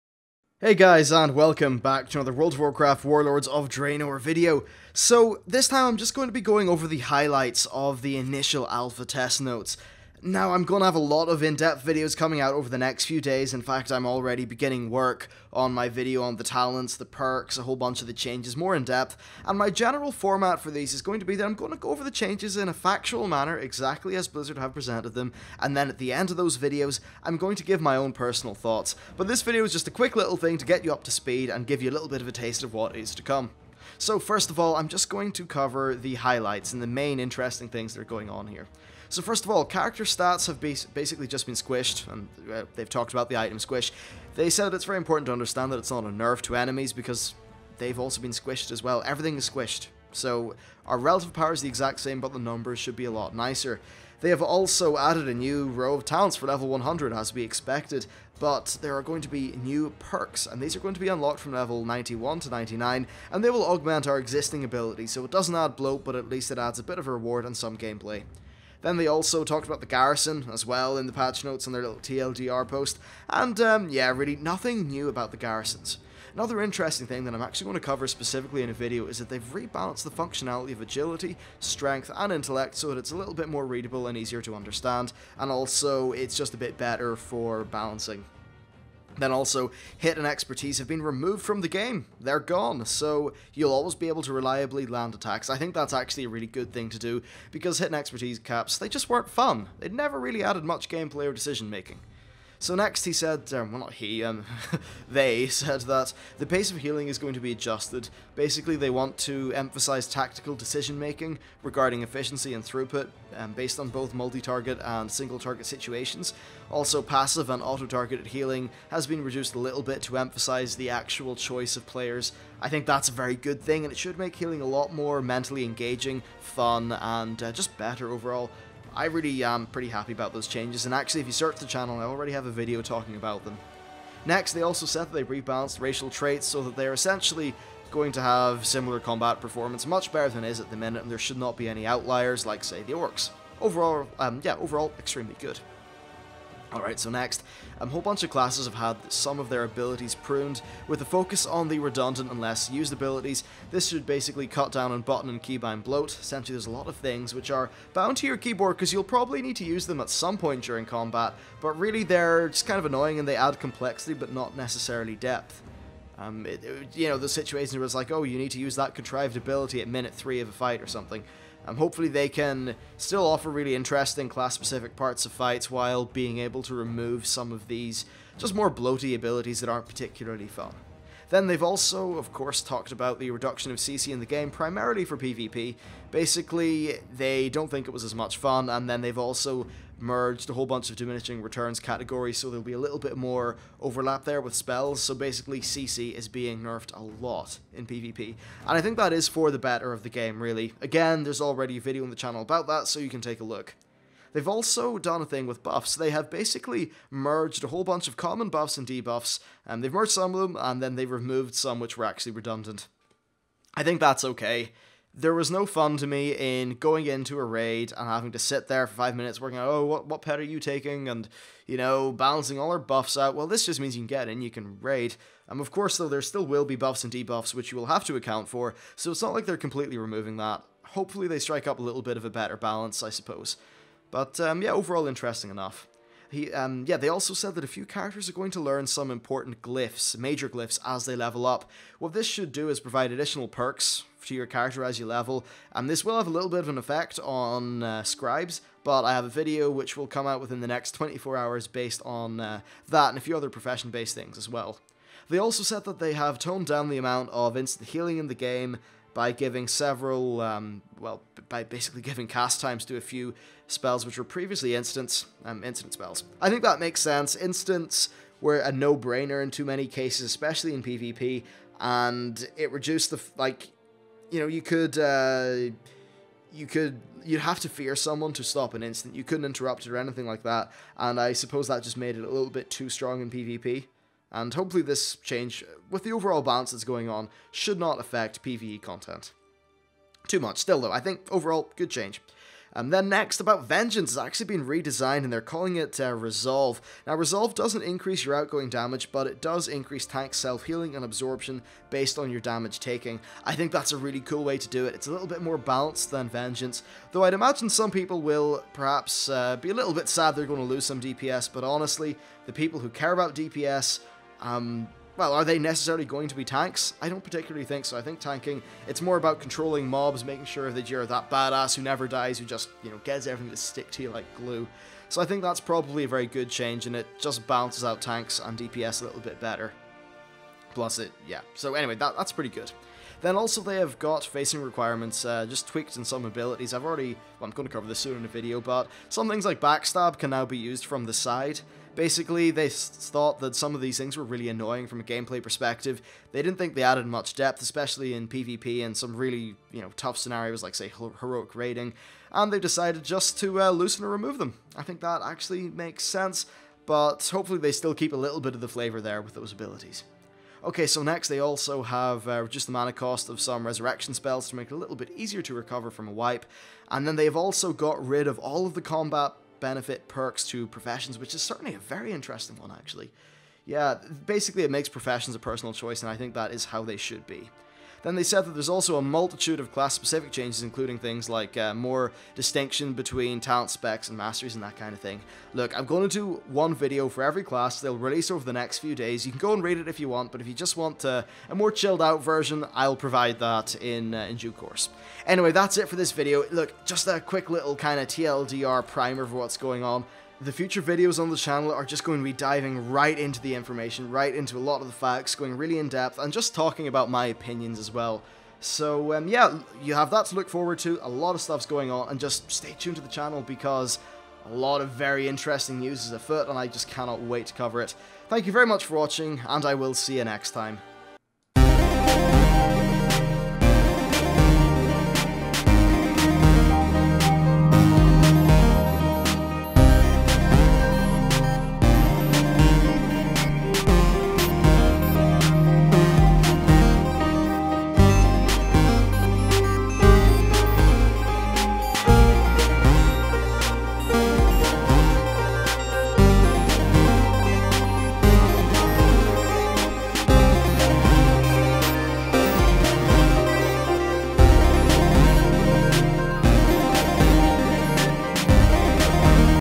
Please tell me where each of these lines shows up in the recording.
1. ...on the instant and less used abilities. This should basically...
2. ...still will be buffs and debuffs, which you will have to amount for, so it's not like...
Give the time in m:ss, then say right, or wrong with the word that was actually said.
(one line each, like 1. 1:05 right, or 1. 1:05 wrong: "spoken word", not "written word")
1. 2:31 wrong: "redundant", not "instant"
2. 3:46 wrong: "account", not "amount".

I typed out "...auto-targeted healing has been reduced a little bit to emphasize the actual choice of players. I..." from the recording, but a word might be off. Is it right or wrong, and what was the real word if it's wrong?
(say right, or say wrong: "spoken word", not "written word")
right.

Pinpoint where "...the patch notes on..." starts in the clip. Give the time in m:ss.
1:11.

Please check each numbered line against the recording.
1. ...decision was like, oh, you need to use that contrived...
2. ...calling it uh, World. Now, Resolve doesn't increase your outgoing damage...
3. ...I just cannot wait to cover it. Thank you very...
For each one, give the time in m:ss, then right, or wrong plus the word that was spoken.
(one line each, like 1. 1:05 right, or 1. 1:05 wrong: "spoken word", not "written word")
1. 2:47 wrong: "situation", not "decision"
2. 4:55 wrong: "Resolve", not "World"
3. 6:56 right.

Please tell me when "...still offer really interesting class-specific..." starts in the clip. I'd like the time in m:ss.
2:52.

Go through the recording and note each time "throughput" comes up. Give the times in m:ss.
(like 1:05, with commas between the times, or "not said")
1:52.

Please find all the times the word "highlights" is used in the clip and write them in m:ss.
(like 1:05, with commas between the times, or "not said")
0:06, 0:36.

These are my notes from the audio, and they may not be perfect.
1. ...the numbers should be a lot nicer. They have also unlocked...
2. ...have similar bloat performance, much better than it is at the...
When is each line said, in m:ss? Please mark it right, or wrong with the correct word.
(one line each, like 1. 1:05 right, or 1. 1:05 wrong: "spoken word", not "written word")
1. 0:52 wrong: "added", not "unlocked"
2. 2:18 wrong: "combat", not "bloat".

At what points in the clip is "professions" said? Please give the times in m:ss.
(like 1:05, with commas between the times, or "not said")
4:13, 6:10, 6:14.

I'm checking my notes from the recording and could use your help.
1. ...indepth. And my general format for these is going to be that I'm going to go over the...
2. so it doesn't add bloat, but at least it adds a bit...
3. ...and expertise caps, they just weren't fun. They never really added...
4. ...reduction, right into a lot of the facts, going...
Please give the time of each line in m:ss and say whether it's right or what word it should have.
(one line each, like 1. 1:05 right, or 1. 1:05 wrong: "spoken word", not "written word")
1. 0:18 wrong: "depth", not "indepth"
2. 1:05 right
3. 1:37 right
4. 6:43 wrong: "information", not "reduction".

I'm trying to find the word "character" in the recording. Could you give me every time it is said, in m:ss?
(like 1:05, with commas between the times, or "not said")
0:39, 3:57, 4:04.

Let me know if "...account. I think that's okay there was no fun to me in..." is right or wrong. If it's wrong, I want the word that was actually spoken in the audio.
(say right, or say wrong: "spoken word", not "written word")
wrong: "redundant", not "account".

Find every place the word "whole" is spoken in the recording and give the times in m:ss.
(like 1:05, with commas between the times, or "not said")
0:17, 2:27, 3:10, 3:27.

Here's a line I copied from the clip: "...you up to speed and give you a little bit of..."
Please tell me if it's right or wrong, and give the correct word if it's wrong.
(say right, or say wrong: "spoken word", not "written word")
right.